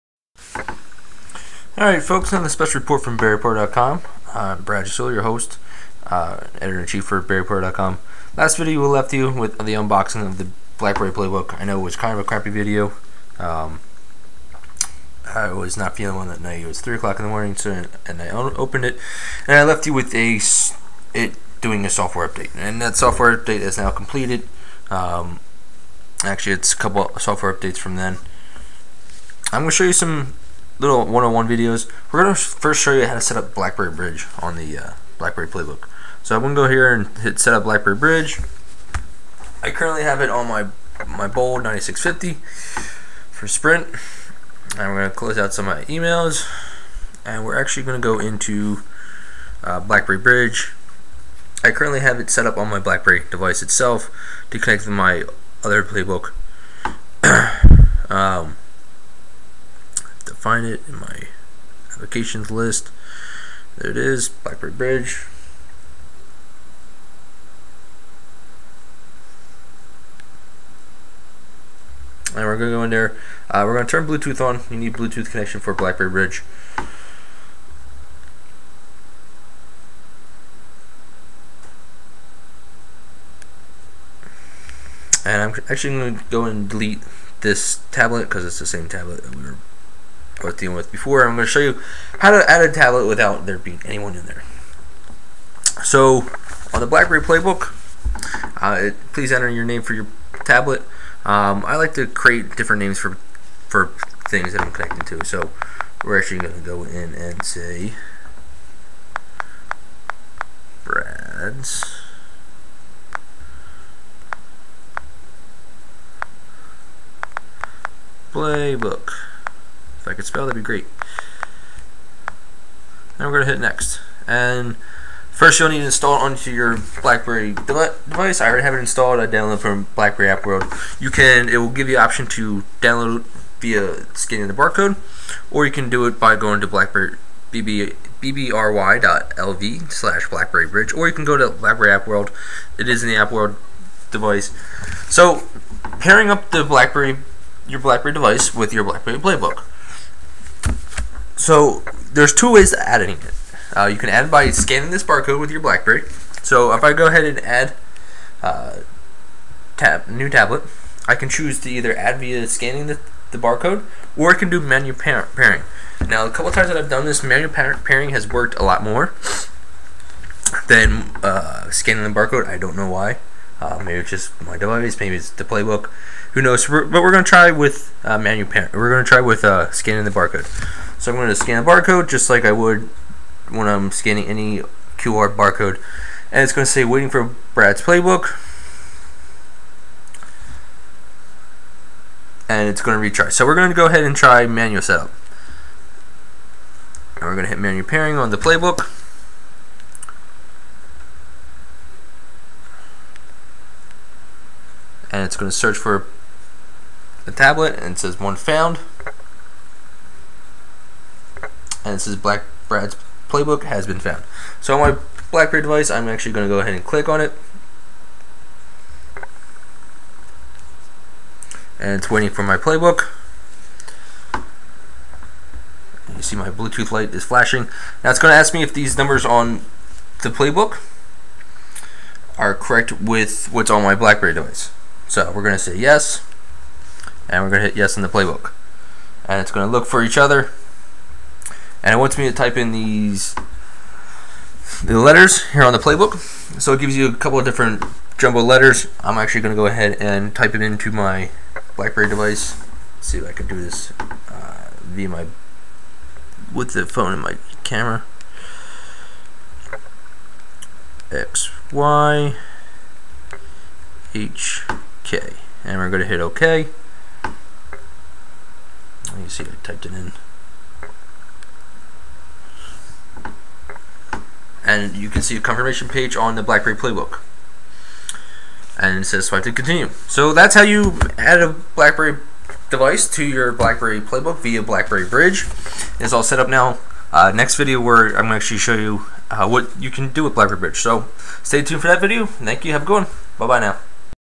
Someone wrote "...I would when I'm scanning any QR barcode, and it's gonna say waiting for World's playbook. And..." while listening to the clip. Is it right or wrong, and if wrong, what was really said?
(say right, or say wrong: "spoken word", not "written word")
wrong: "Brad", not "World".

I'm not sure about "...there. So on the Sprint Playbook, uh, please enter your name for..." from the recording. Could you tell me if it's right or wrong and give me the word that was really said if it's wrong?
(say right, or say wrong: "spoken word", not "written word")
wrong: "BlackBerry", not "Sprint".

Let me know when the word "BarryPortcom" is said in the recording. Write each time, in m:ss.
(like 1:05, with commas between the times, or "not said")
0:03, 0:07.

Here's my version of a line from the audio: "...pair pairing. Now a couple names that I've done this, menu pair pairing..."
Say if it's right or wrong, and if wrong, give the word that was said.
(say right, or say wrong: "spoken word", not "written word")
wrong: "times", not "names".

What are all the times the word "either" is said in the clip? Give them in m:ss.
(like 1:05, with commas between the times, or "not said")
2:41.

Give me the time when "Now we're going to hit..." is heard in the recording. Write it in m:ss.
2:03.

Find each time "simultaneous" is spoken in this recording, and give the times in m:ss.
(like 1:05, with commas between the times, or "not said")
not said.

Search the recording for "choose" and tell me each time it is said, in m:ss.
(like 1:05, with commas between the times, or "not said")
2:41.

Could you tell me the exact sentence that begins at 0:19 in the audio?
And I left you with a it doing a software update.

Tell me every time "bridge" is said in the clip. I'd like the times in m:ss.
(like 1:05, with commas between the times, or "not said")
0:33, 0:37, 0:50, 1:04, 1:16, 2:20, 4:45, 4:50.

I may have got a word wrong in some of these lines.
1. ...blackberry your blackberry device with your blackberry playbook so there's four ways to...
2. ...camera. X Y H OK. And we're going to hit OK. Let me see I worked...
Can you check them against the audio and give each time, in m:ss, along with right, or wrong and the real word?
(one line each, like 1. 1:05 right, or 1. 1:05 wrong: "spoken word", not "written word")
1. 2:26 wrong: "two", not "four"
2. 4:17 wrong: "typed", not "worked".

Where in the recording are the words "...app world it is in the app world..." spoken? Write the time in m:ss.
2:21.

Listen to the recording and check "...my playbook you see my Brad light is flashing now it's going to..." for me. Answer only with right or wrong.
wrong.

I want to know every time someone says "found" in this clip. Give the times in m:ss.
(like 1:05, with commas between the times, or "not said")
3:28, 3:33.